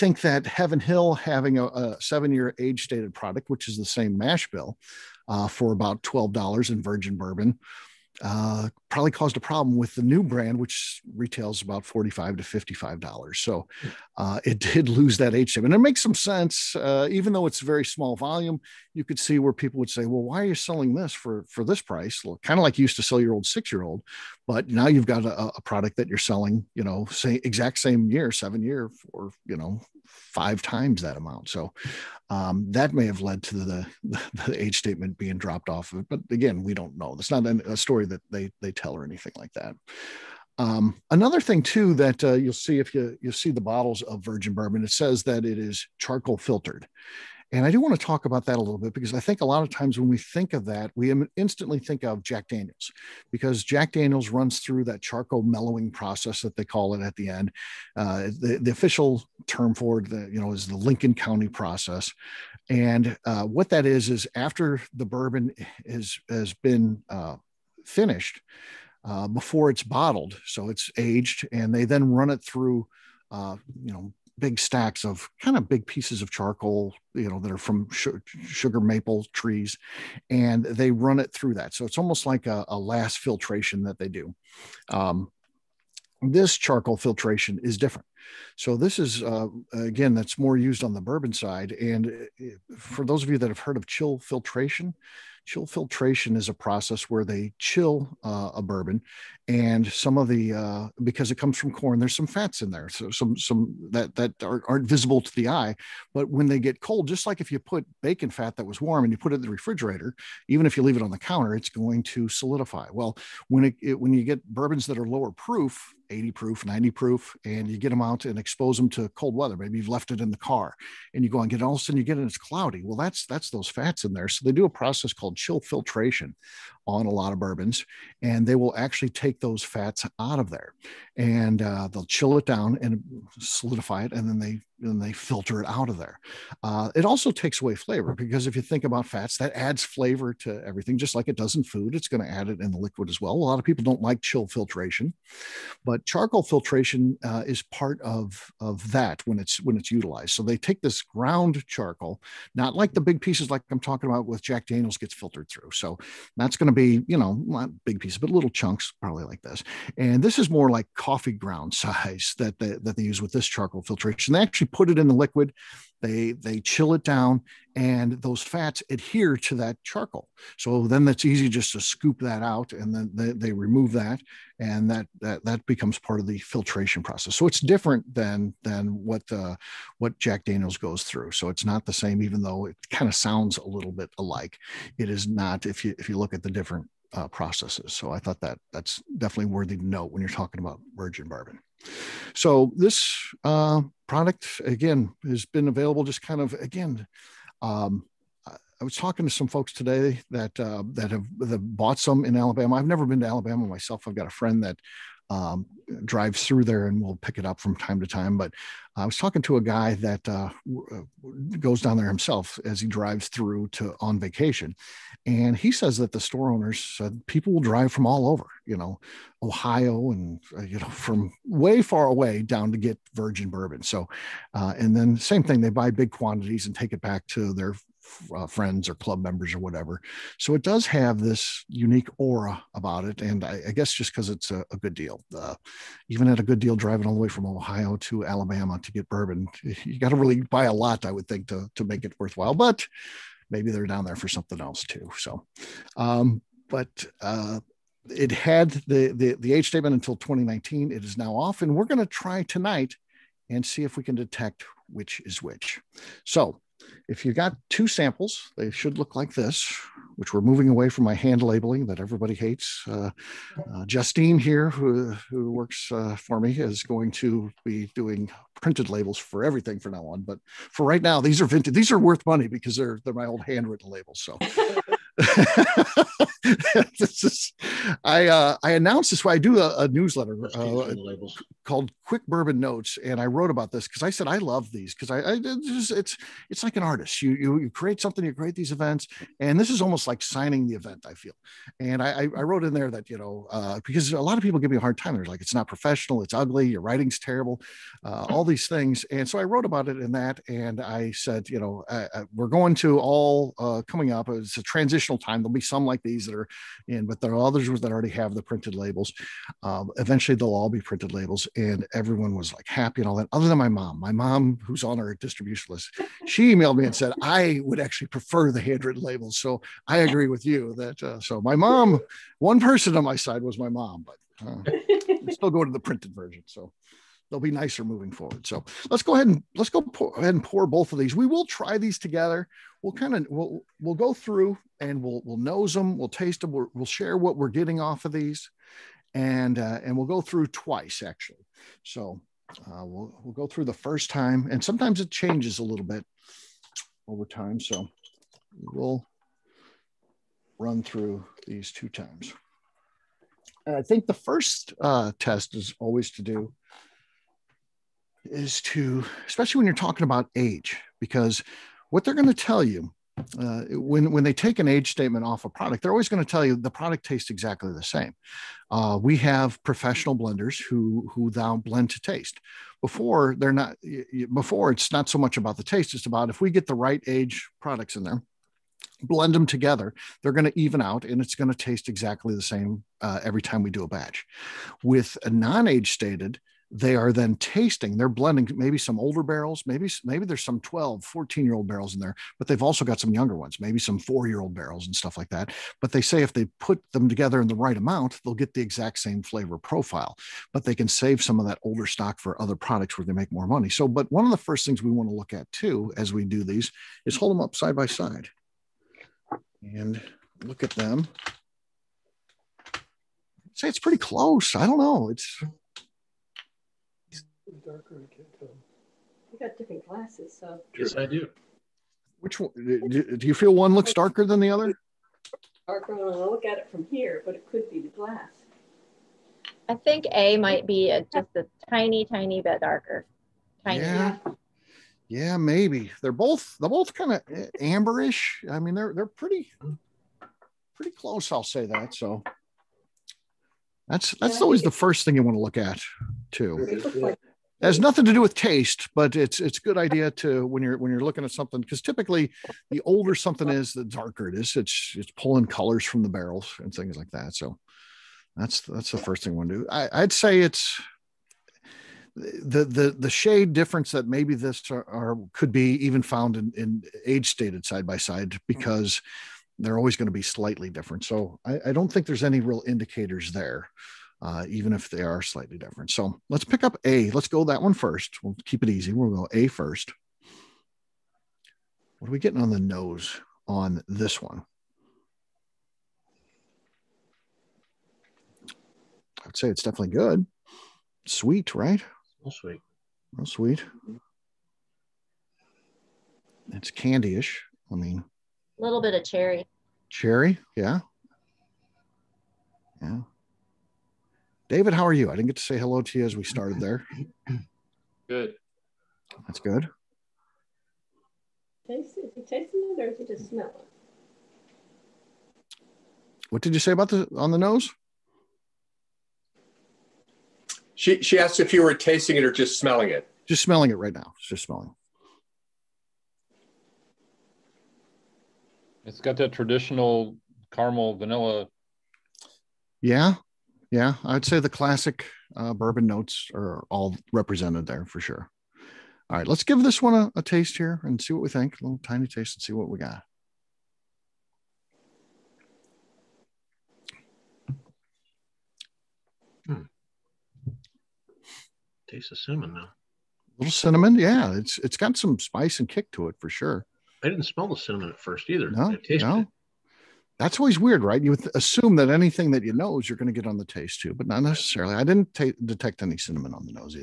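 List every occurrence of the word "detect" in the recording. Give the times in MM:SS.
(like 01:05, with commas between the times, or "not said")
04:14, 09:25.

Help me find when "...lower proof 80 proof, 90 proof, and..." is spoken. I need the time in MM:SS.
01:55.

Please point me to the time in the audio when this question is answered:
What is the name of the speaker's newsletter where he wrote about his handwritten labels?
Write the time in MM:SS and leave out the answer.
04:42.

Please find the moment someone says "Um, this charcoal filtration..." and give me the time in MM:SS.
01:24.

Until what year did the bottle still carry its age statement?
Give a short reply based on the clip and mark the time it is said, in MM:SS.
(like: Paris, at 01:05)
2019, at 04:10.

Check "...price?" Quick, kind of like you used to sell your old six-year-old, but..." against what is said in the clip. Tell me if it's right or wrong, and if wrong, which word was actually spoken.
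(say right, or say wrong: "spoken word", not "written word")
wrong: "Well", not "Quick".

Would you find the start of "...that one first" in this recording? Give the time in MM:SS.
07:57.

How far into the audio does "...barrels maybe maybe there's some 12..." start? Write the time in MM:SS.
06:29.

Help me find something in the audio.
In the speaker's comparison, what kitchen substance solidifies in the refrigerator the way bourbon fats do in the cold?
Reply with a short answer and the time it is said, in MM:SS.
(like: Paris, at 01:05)
bacon fat, at 01:48.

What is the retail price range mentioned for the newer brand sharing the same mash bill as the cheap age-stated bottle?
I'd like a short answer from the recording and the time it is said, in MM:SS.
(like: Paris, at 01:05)
$45 to $55, at 00:11.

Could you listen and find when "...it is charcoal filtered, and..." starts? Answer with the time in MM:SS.
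00:45.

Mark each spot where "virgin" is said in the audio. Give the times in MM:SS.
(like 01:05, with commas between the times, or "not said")
00:06, 00:44, 03:10, 03:43.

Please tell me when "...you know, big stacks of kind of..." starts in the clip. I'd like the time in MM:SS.
01:13.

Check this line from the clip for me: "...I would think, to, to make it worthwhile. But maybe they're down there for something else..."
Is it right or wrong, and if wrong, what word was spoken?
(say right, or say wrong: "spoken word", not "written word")
right.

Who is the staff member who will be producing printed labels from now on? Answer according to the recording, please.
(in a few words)
Justine.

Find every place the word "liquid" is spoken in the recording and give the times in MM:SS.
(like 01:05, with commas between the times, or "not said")
02:22, 02:45.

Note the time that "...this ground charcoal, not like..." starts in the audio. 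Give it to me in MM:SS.
02:30.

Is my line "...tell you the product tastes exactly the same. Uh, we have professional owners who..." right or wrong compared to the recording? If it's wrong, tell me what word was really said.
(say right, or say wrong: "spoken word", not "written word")
wrong: "blenders", not "owners".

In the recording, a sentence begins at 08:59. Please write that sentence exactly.
All right, let's give this one a, a taste here and see what we think.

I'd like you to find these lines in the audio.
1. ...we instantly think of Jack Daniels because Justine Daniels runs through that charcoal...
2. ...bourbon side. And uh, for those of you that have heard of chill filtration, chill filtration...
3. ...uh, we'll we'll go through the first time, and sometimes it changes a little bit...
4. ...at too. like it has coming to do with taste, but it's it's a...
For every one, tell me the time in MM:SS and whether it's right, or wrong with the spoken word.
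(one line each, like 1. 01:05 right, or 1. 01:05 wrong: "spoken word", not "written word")
1. 00:50 wrong: "Jack", not "Justine"
2. 01:31 right
3. 05:42 right
4. 07:25 wrong: "nothing", not "coming".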